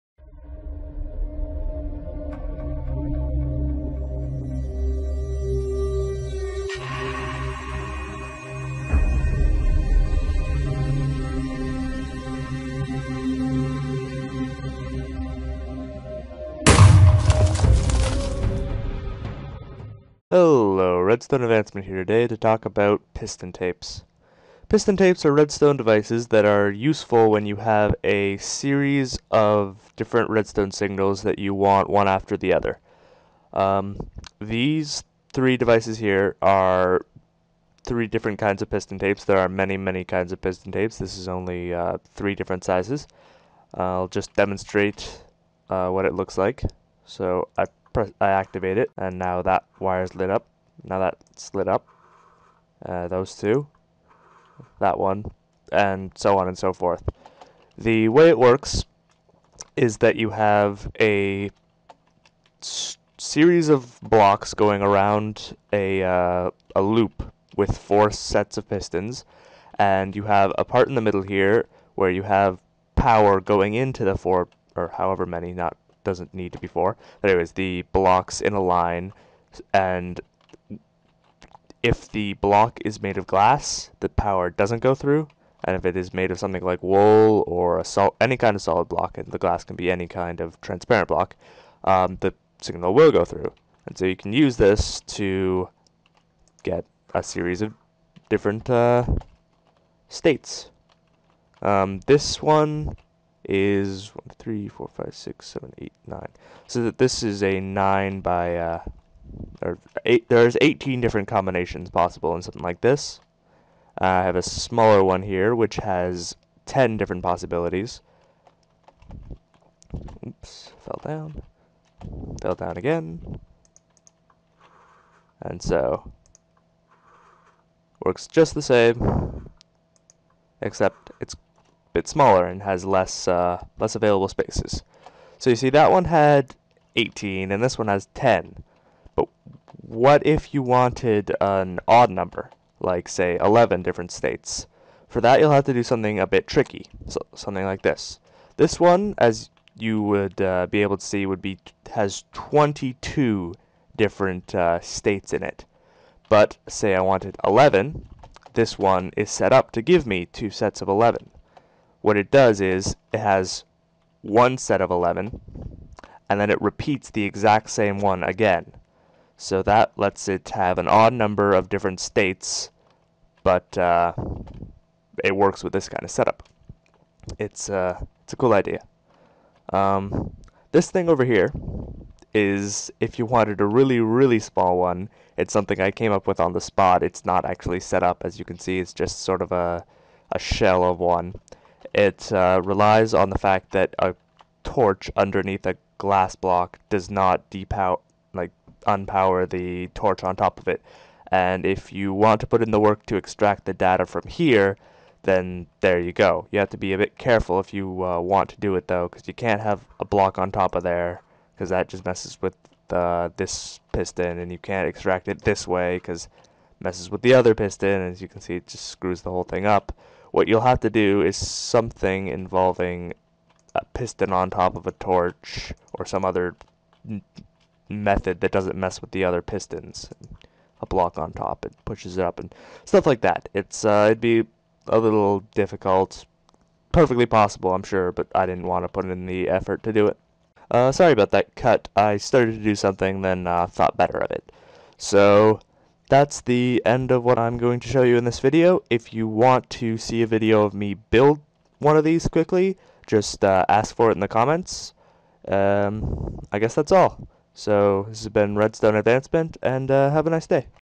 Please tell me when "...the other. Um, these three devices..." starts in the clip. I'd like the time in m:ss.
0:32.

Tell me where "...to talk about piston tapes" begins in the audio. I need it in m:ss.
0:22.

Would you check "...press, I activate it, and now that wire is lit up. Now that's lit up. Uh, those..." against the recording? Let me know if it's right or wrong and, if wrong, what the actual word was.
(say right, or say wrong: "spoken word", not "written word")
right.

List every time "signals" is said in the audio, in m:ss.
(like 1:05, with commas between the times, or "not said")
0:30, 1:32.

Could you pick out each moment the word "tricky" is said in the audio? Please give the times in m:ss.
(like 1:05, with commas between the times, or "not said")
2:26.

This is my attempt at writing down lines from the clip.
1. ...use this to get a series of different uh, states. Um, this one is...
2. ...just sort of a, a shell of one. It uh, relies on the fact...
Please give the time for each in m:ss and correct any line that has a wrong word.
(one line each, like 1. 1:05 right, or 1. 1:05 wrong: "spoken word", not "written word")
1. 1:34 right
2. 3:08 right.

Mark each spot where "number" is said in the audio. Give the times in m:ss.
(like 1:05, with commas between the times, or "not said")
2:22, 2:51.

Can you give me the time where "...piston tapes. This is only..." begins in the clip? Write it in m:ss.
0:40.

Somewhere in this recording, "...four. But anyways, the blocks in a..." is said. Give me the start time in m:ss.
1:16.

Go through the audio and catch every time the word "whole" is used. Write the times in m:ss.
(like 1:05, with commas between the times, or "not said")
3:39.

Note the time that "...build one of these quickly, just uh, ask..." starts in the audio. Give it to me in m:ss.
4:10.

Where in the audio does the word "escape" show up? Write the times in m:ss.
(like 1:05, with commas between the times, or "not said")
not said.